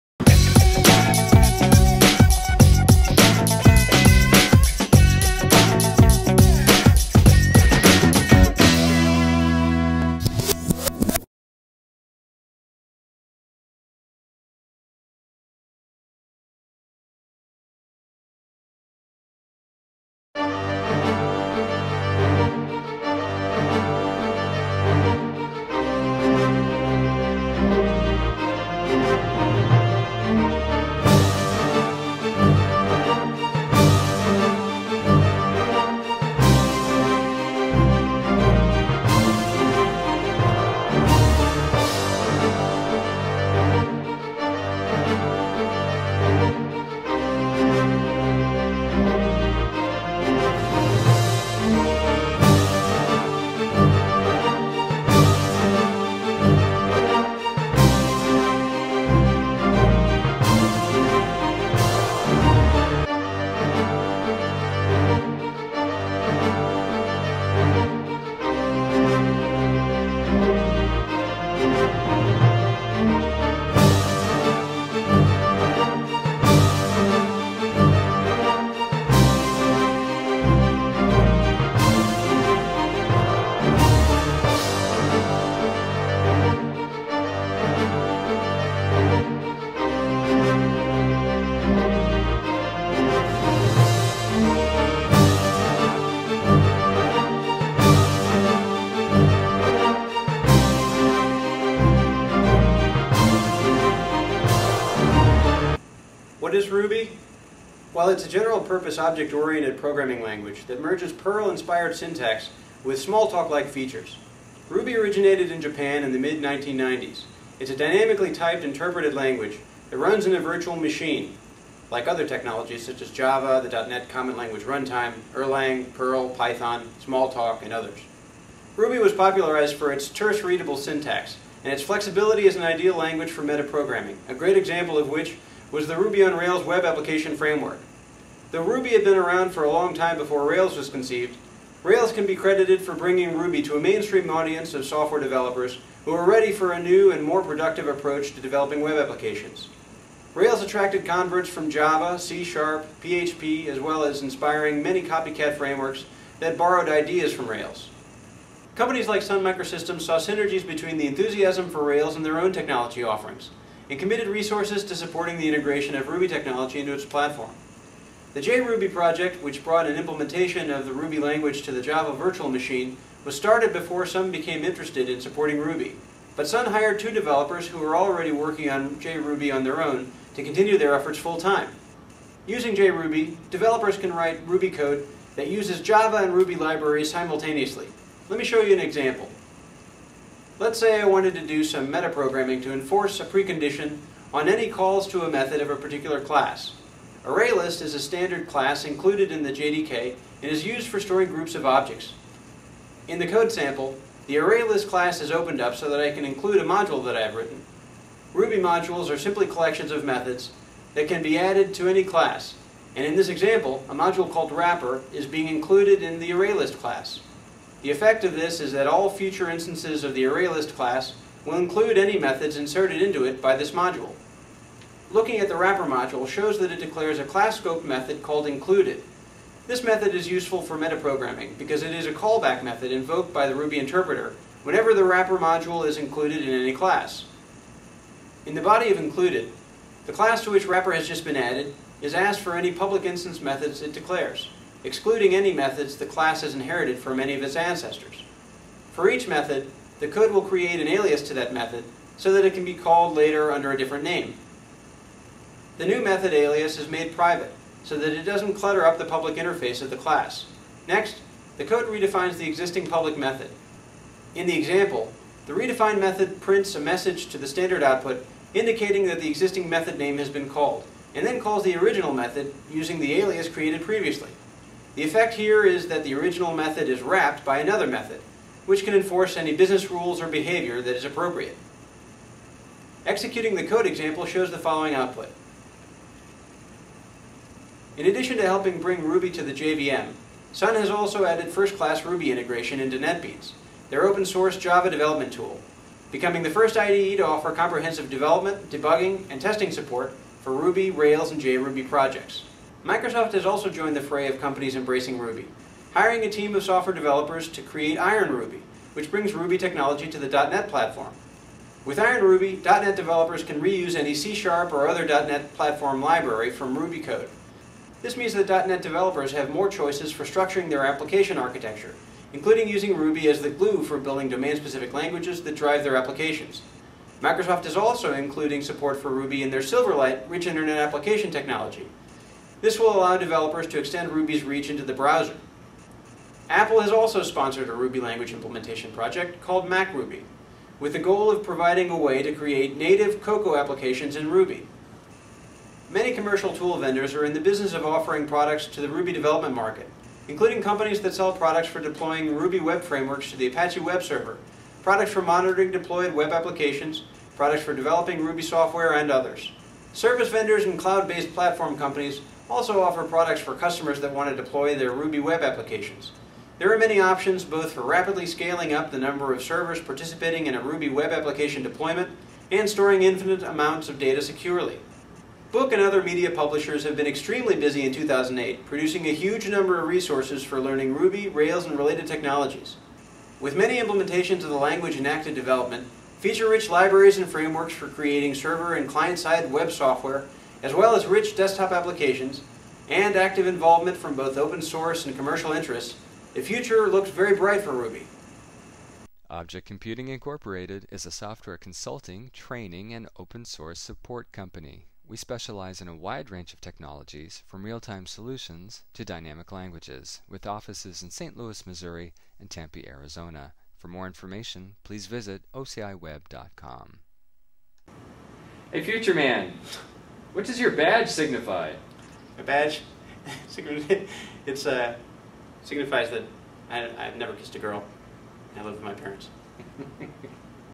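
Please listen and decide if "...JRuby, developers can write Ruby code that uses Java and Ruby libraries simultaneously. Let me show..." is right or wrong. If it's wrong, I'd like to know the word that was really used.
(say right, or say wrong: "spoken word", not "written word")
right.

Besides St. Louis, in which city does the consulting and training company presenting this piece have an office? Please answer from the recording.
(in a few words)
Tempe, Arizona.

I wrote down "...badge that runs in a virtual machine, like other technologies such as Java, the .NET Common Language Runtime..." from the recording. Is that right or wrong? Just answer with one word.
wrong.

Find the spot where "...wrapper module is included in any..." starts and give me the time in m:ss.
3:55.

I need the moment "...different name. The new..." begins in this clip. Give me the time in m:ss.
4:13.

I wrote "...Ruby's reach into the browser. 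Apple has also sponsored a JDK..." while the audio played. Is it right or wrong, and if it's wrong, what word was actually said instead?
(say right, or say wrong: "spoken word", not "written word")
wrong: "Ruby", not "JDK".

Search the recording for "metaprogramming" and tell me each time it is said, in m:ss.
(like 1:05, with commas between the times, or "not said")
2:13, 3:11, 3:50.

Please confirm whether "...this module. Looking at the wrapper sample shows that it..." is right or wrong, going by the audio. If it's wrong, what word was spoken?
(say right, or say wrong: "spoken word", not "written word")
wrong: "module", not "sample".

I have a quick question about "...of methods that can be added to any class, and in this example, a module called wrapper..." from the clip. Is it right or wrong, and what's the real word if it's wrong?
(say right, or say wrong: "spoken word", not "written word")
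right.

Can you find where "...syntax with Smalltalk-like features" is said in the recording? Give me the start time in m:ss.
1:51.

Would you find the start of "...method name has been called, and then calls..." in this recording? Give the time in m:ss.
4:29.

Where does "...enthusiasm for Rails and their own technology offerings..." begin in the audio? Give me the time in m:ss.
2:41.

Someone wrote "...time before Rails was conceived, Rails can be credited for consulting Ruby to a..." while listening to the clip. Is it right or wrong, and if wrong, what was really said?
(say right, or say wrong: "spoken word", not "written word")
wrong: "bringing", not "consulting".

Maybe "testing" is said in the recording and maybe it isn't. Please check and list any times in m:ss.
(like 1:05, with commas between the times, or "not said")
4:59.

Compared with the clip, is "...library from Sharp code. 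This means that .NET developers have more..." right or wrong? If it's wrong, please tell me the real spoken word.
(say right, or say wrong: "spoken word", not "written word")
wrong: "Ruby", not "Sharp".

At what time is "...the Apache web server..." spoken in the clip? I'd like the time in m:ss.
5:53.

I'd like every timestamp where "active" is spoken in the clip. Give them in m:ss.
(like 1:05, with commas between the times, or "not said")
6:25, 6:33.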